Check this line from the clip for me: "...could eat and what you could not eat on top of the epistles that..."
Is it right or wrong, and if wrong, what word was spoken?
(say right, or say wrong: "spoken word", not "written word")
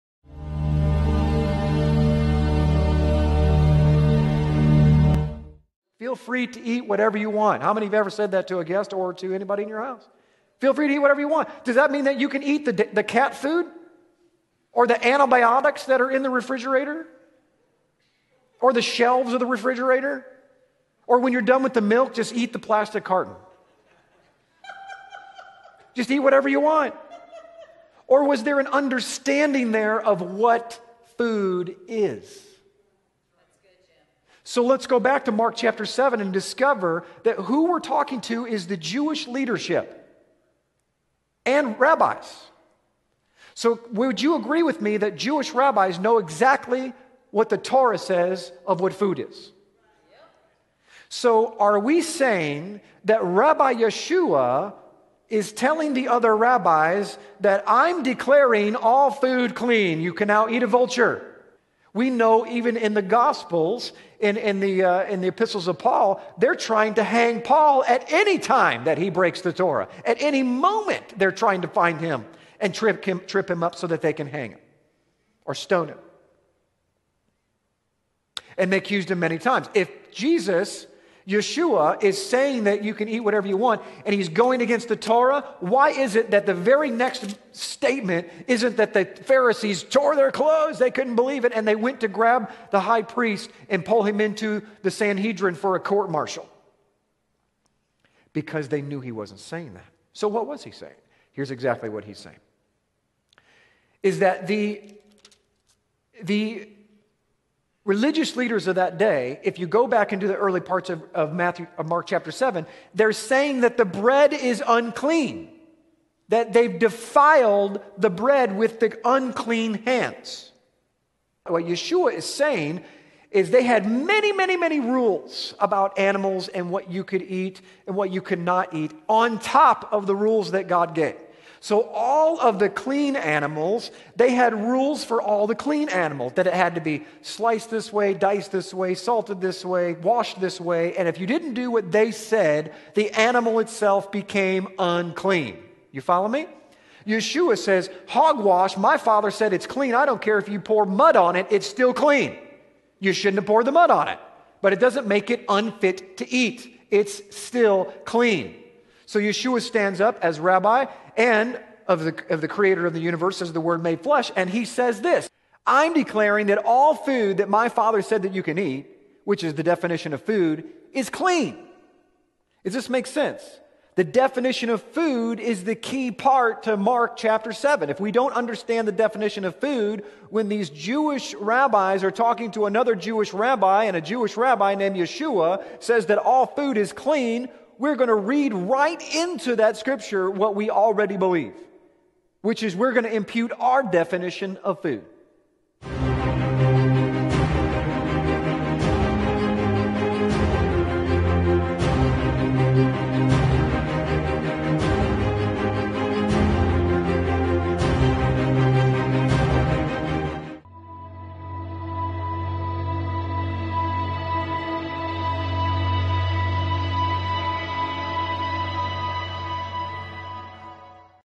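wrong: "rules", not "epistles".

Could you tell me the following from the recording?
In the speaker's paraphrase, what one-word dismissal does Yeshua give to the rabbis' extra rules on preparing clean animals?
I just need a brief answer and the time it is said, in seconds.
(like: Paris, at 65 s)
Hogwash, at 148 s.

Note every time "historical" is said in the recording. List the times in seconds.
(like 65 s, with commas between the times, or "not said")
not said.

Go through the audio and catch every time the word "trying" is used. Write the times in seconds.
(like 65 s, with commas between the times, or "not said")
66 s, 71 s.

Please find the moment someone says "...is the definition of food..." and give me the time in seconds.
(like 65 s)
169 s.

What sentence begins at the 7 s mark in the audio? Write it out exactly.
How many have ever said that to a guest or to anybody in your house?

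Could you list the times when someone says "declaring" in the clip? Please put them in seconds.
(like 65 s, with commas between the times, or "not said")
58 s, 165 s.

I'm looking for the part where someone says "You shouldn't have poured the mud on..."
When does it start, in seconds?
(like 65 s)
152 s.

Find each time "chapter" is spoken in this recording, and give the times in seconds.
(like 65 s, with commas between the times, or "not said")
35 s, 112 s, 177 s.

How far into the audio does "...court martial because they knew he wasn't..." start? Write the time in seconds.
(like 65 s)
95 s.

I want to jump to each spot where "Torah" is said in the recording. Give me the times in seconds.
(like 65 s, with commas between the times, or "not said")
47 s, 69 s, 84 s.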